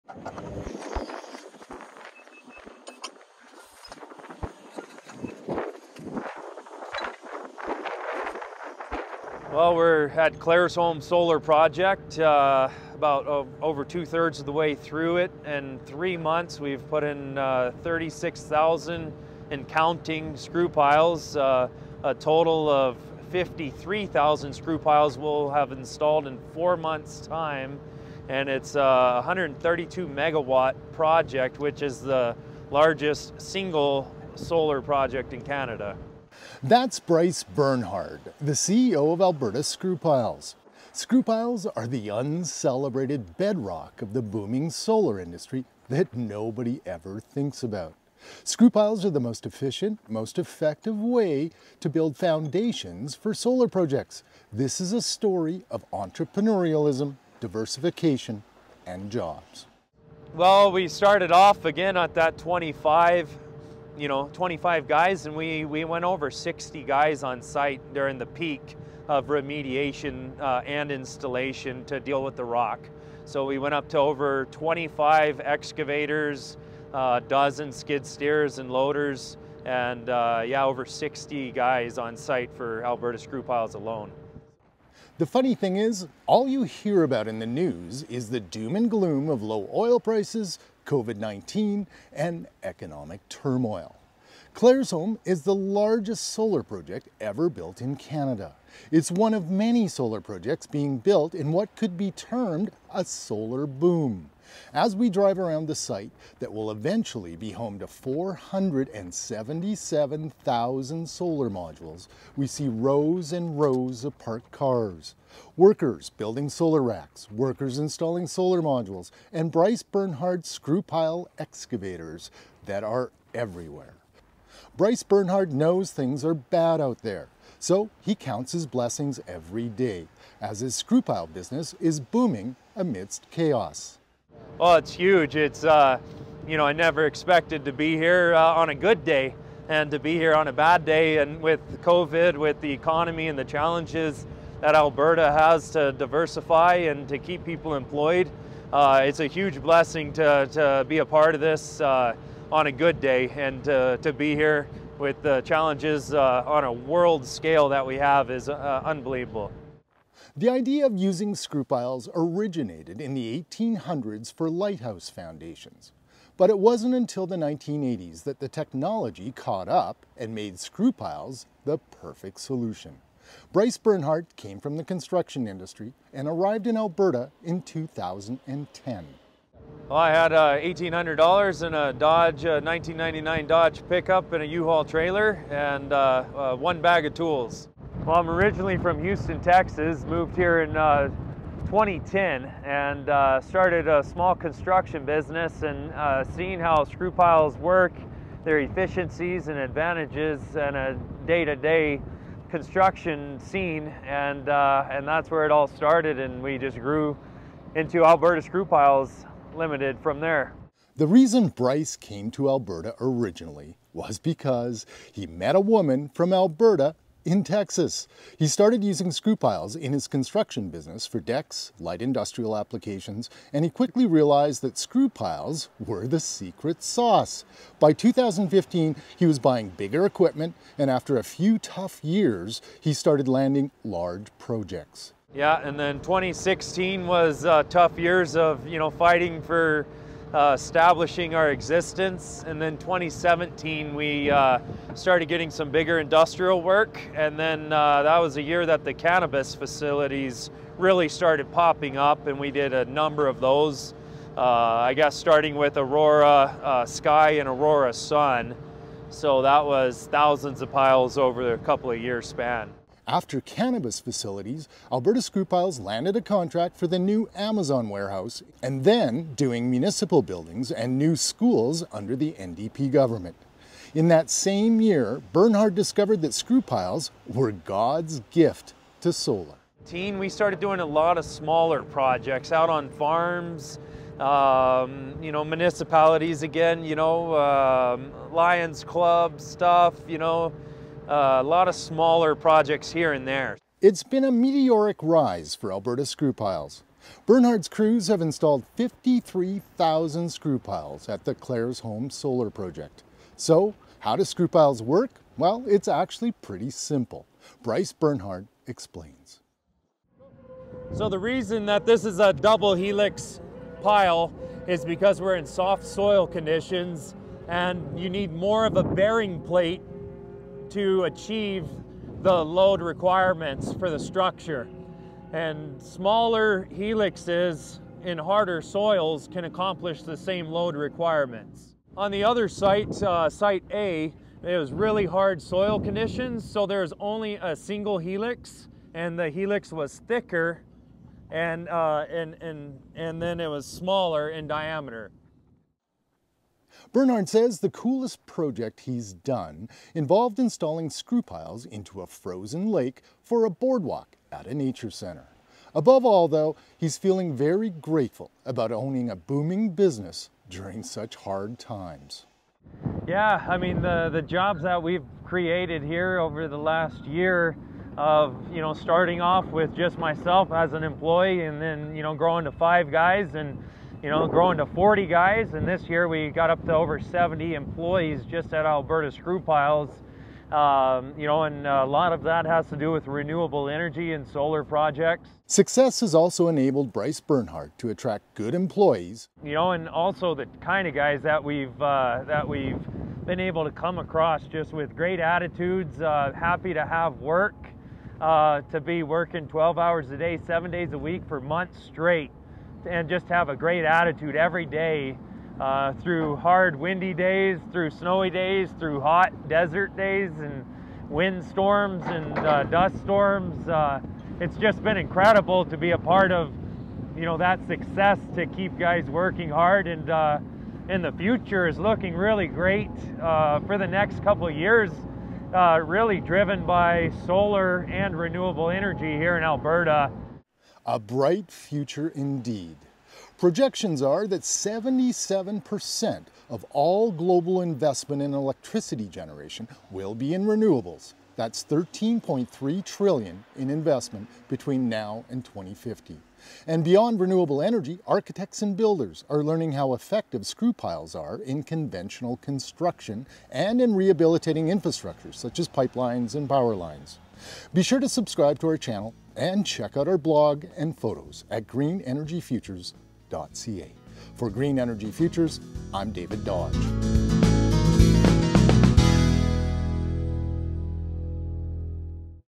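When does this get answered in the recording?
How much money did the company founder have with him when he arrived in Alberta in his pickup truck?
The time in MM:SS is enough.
03:00.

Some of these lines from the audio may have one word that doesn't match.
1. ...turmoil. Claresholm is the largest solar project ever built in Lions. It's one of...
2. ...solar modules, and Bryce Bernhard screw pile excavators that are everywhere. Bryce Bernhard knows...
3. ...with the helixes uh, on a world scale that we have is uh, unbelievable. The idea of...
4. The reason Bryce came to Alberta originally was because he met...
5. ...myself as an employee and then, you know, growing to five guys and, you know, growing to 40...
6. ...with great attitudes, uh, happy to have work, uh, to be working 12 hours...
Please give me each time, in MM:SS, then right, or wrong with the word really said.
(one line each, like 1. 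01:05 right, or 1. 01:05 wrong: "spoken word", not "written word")
1. 01:33 wrong: "Canada", not "Lions"
2. 01:58 right
3. 02:34 wrong: "challenges", not "helixes"
4. 03:30 right
5. 06:09 right
6. 06:34 right.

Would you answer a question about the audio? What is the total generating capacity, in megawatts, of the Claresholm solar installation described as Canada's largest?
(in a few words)
132 megawatts.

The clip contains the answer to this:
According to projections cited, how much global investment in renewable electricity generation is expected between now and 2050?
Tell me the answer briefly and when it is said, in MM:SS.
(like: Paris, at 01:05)
13.3 trillion, at 07:21.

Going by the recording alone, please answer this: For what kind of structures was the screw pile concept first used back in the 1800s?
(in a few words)
Lighthouse foundations.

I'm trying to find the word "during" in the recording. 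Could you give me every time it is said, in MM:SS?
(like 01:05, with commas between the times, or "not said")
01:07, 06:00.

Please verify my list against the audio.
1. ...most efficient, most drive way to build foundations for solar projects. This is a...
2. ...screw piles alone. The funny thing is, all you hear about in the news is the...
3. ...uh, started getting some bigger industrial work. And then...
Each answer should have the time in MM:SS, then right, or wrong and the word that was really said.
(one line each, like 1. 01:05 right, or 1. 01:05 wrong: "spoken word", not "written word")
1. 00:49 wrong: "effective", not "drive"
2. 01:23 right
3. 04:04 right.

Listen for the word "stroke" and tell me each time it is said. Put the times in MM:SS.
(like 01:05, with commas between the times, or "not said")
not said.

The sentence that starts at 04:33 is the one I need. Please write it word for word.
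In that same year, Bernhard discovered that Screwpiles were God's gift to solar.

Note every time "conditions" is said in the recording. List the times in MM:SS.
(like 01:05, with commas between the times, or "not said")
05:16, 05:35.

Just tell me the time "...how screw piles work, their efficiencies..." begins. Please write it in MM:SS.
03:16.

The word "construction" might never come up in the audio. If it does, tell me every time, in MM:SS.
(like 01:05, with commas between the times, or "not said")
02:54, 03:14, 03:22, 03:40, 07:32.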